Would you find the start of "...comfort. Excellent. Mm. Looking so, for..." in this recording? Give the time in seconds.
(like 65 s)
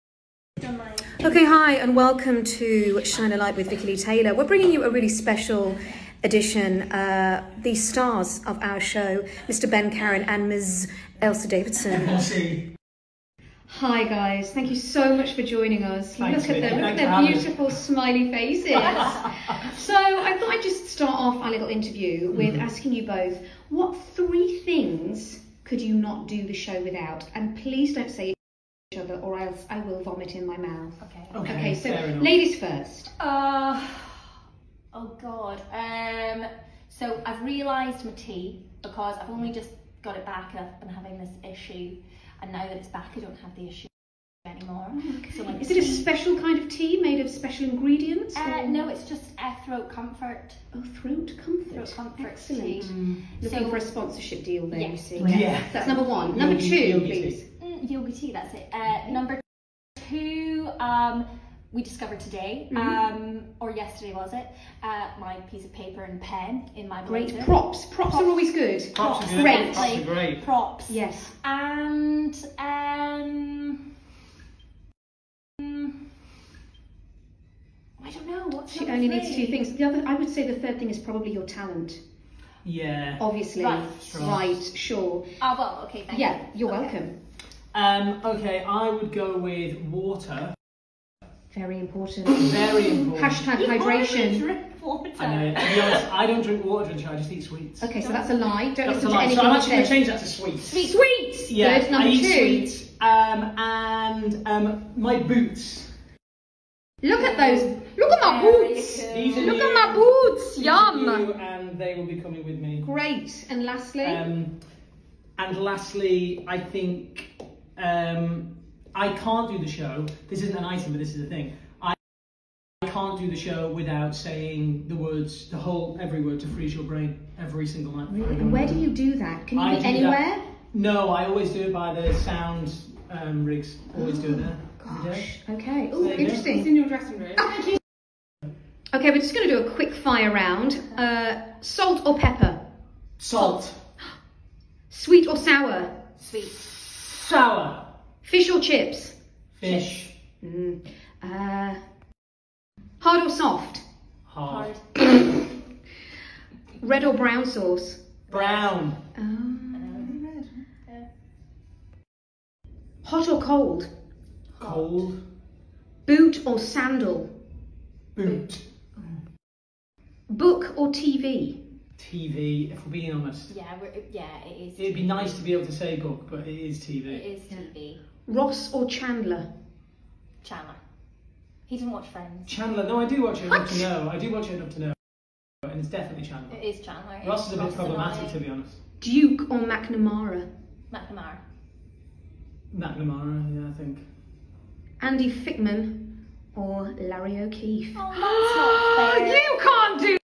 51 s.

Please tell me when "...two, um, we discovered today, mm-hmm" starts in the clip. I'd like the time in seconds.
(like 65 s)
60 s.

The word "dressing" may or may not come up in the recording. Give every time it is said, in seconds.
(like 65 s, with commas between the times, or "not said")
136 s.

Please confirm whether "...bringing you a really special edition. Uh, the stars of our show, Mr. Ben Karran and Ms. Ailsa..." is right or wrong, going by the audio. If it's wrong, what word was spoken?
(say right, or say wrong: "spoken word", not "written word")
right.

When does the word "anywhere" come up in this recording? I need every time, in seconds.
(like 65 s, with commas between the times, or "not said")
129 s.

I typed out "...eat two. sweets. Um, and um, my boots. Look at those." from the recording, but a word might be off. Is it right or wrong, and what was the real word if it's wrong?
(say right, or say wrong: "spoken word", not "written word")
right.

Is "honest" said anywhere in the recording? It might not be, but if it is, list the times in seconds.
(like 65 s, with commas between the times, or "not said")
95 s, 173 s, 188 s.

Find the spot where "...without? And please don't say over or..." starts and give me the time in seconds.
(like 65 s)
26 s.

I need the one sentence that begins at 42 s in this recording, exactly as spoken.
And now that it's back, I don't have the issue anymore.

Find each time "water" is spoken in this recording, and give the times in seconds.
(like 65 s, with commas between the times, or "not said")
89 s, 96 s.